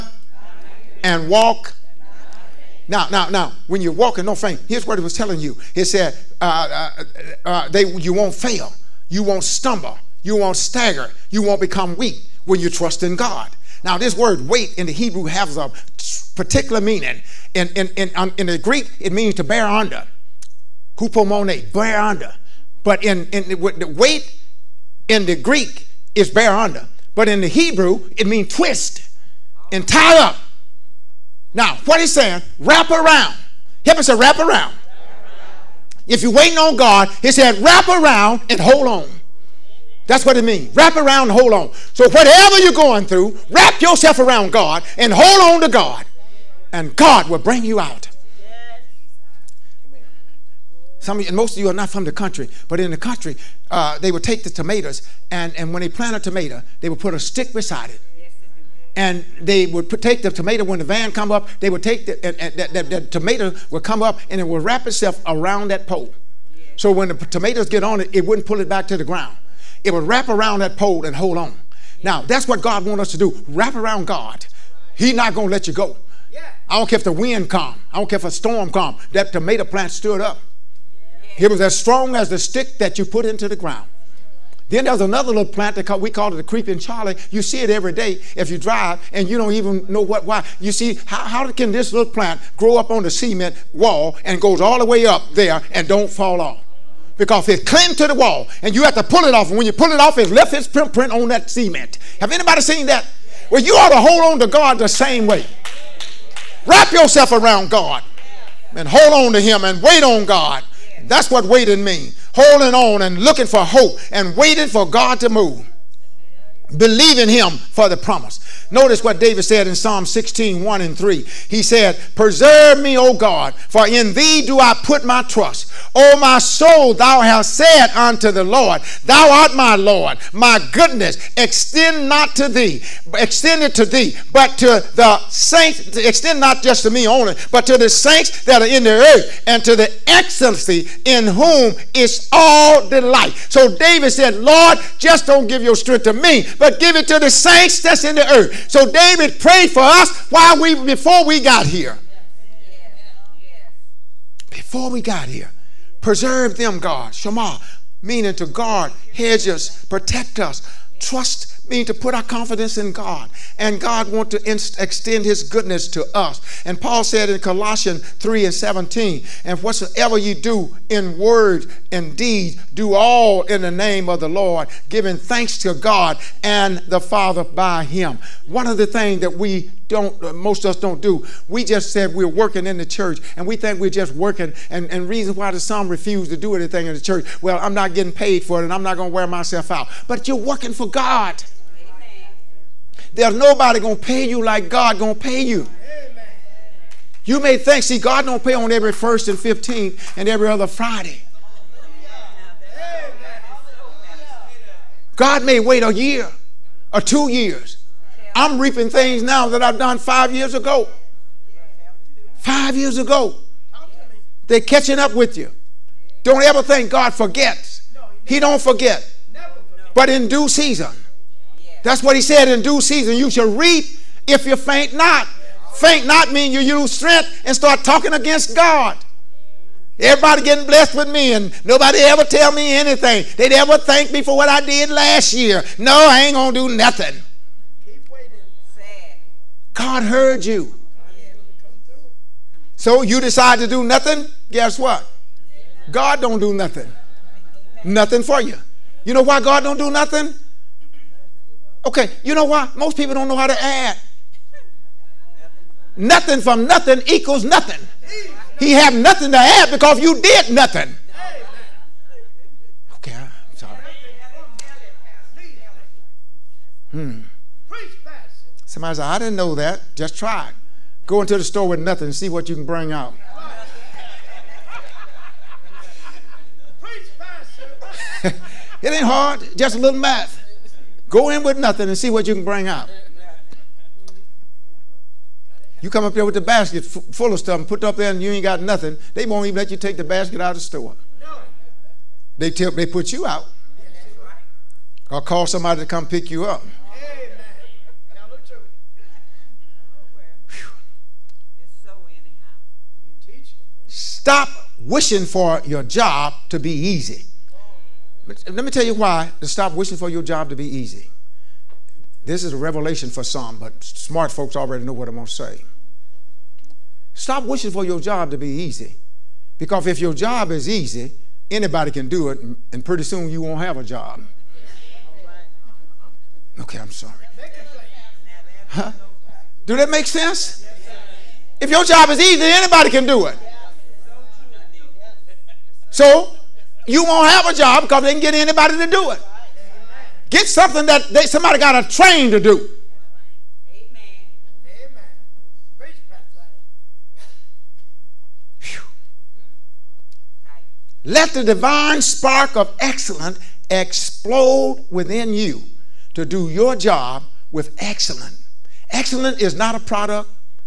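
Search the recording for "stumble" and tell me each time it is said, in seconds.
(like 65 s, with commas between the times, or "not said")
9 s.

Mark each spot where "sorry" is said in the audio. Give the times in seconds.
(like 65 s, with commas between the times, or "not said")
263 s, 326 s.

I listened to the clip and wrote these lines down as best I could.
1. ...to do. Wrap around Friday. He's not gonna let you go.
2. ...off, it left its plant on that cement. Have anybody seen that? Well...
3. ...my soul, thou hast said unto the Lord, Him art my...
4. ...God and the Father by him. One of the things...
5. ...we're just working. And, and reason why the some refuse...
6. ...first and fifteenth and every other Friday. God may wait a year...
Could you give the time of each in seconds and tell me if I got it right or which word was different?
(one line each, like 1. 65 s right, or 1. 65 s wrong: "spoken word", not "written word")
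1. 73 s wrong: "God", not "Friday"
2. 99 s wrong: "print", not "plant"
3. 126 s wrong: "Thou", not "Him"
4. 175 s right
5. 183 s right
6. 198 s right.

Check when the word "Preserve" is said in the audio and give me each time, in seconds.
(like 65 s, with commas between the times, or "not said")
122 s, 156 s.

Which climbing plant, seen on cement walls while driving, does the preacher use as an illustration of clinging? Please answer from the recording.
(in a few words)
Creeping Charlie.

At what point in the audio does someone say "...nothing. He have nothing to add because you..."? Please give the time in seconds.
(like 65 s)
257 s.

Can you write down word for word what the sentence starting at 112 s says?
Holding on and looking for hope and waiting for God to move.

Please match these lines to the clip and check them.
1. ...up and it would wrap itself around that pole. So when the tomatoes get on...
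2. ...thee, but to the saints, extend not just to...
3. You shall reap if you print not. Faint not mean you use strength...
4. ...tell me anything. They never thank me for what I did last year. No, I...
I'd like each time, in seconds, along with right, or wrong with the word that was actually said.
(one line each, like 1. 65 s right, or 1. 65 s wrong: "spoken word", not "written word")
1. 64 s right
2. 133 s right
3. 223 s wrong: "faint", not "print"
4. 232 s right.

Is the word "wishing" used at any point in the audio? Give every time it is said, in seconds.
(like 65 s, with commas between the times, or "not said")
304 s, 309 s, 317 s.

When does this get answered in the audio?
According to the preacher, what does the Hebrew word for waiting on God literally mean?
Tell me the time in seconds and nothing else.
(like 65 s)
28 s.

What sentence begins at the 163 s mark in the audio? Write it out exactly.
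And God want to extend his goodness to us.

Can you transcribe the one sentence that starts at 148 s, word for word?
So David prayed for us while we before we got here.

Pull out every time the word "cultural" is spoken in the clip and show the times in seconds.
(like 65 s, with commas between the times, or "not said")
not said.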